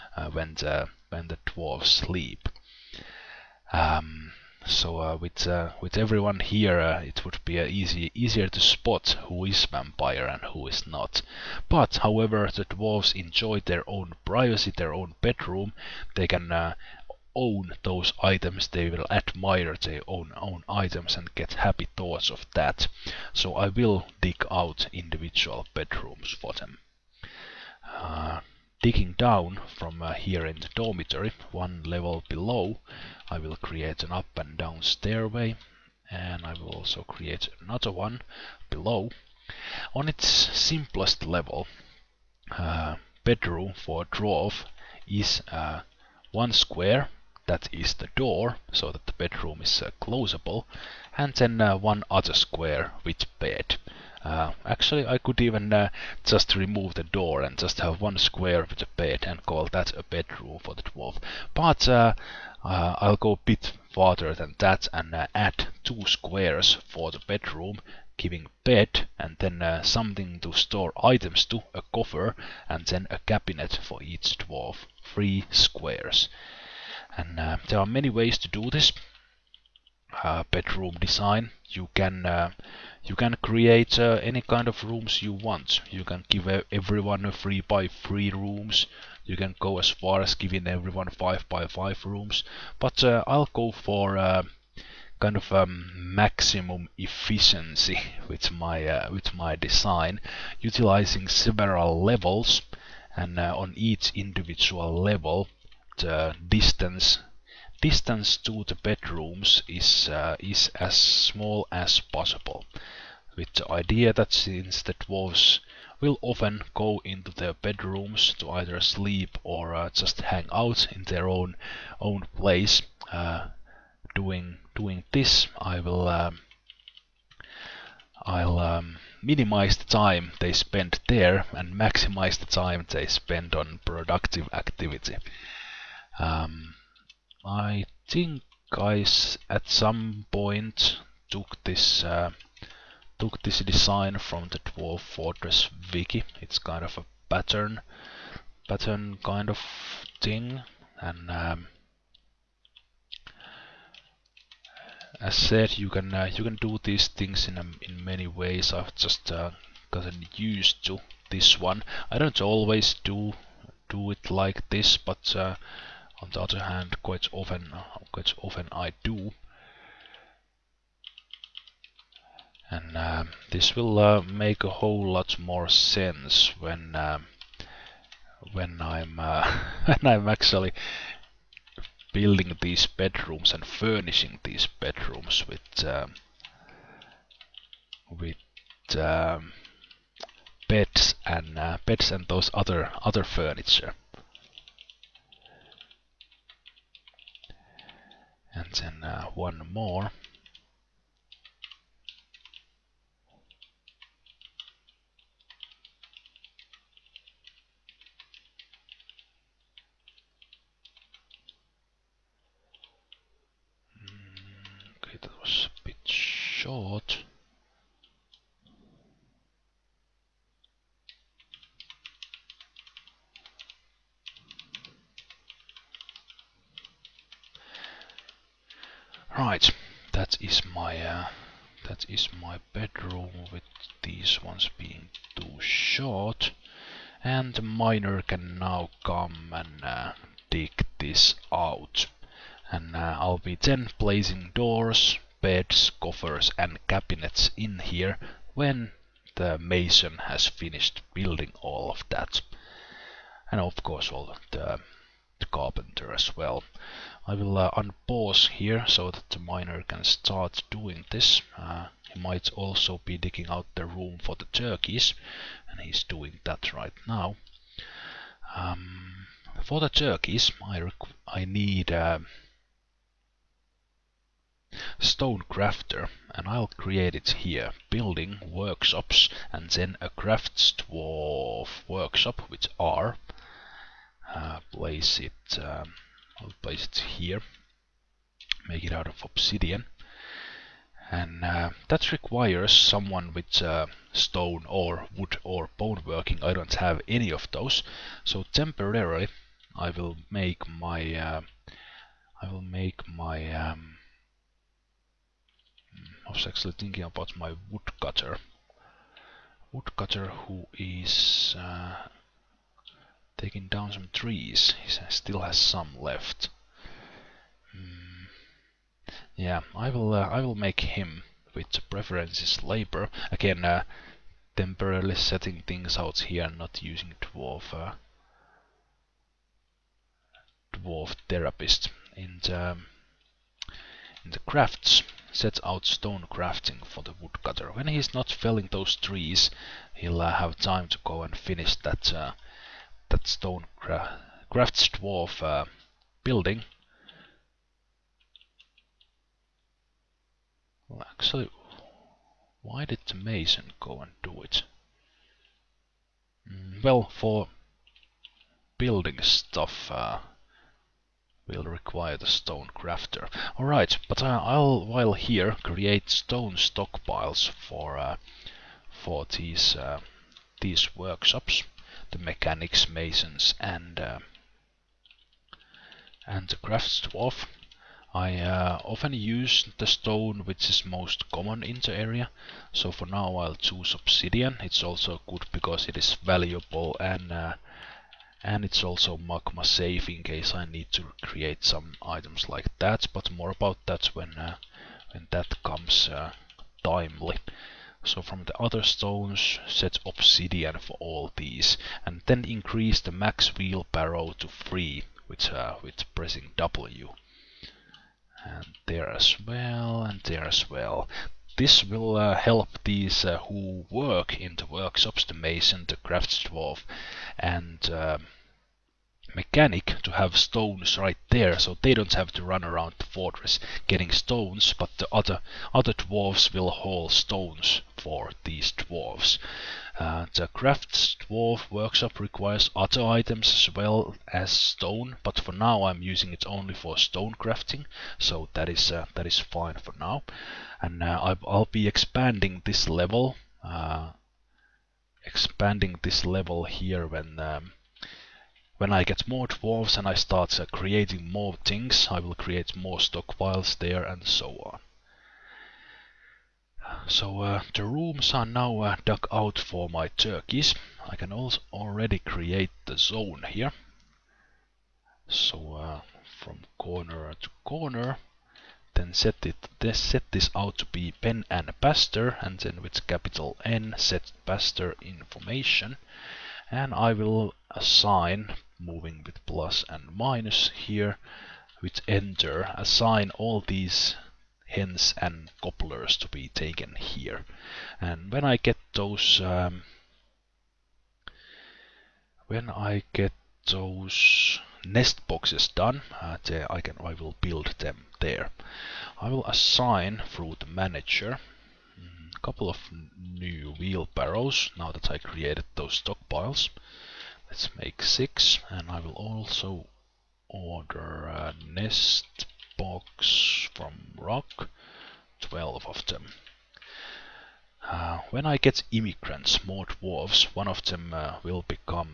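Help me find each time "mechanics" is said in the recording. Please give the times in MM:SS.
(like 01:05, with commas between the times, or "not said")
06:12, 06:59.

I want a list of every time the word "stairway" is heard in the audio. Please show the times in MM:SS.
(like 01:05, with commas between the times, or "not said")
00:34.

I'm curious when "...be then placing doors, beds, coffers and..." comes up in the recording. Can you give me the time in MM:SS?
04:03.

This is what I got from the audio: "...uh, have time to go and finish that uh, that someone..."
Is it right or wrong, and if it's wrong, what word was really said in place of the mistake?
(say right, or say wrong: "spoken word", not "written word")
wrong: "stone", not "someone".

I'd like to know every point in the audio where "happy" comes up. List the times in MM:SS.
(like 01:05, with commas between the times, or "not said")
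00:21.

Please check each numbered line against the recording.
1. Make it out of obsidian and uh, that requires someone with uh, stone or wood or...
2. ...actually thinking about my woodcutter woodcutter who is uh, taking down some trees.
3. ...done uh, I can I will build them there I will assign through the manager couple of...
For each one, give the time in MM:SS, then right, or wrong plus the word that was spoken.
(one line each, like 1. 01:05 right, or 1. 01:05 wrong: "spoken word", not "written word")
1. 04:48 right
2. 05:06 right
3. 08:15 right.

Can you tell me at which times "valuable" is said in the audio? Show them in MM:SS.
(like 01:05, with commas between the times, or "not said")
06:26.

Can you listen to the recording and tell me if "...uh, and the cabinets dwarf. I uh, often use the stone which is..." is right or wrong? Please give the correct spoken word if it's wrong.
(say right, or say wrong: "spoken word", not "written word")
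wrong: "crafts", not "cabinets".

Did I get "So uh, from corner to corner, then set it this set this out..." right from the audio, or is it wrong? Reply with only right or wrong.
right.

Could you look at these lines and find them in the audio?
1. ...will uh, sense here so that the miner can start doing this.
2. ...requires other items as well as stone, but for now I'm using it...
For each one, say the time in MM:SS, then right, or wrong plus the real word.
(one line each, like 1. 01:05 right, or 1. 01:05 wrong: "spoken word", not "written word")
1. 04:17 wrong: "unpause", not "sense"
2. 07:12 right.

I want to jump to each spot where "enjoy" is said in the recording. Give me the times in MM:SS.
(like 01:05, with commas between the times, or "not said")
00:13.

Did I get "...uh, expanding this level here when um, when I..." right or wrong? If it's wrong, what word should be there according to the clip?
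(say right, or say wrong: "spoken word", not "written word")
right.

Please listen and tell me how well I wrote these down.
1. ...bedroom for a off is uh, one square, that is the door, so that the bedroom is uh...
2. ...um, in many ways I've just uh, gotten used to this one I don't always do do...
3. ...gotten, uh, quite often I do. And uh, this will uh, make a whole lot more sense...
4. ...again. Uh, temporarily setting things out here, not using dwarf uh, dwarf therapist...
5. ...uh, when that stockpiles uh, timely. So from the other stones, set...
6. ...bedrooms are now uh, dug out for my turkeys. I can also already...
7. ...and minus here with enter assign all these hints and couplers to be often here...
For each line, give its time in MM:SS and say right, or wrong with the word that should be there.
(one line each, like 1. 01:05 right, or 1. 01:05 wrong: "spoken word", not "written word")
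1. 00:43 right
2. 02:37 right
3. 02:47 wrong: "often", not "gotten"
4. 05:23 right
5. 06:34 wrong: "comes", not "stockpiles"
6. 07:37 wrong: "rooms", not "bedrooms"
7. 07:59 wrong: "taken", not "often".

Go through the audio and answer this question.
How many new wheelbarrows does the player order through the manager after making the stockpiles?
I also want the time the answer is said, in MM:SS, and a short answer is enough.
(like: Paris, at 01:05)
6, at 08:28.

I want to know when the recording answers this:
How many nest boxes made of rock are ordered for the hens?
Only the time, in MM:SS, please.
08:35.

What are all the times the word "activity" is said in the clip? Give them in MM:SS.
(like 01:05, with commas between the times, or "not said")
02:14.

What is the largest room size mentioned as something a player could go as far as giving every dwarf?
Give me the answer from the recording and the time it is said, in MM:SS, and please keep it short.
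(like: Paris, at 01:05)
5 by 5, at 01:31.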